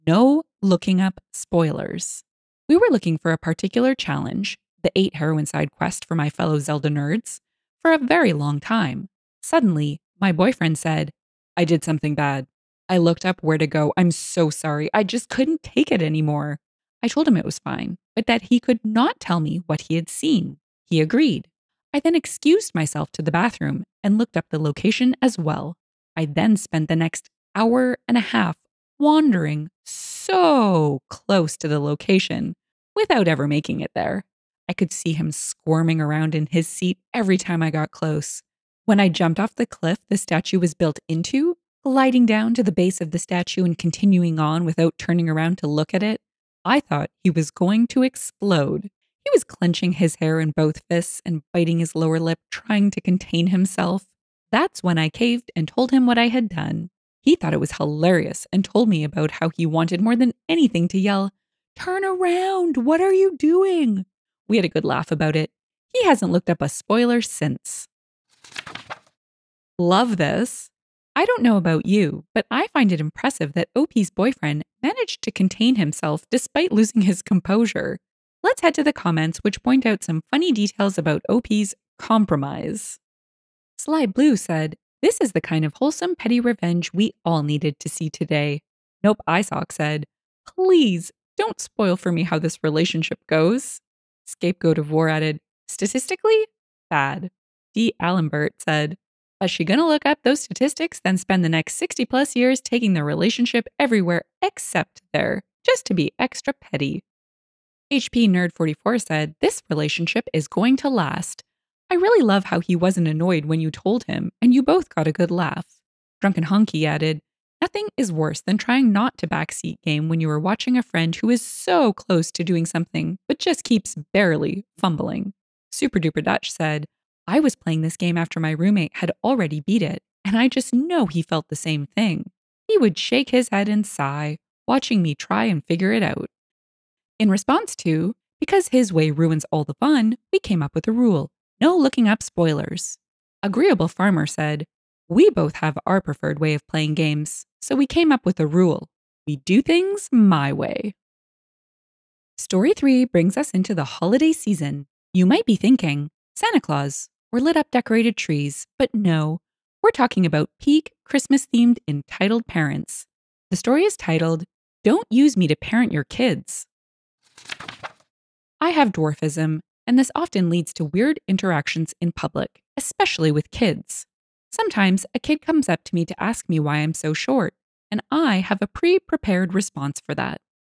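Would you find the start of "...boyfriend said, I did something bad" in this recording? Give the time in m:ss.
0:10.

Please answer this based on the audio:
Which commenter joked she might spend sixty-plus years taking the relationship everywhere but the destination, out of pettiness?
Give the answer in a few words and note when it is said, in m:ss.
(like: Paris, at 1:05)
D. Allenbert, at 1:37.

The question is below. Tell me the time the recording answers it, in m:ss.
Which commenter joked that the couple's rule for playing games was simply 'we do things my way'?
2:23.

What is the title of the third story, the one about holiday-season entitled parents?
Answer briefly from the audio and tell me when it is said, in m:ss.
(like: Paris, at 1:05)
Don't Use Me to Parent Your Kids, at 2:44.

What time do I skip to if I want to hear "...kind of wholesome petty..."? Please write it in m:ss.
1:25.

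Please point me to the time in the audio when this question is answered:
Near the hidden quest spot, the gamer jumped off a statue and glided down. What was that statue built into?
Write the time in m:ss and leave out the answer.
0:39.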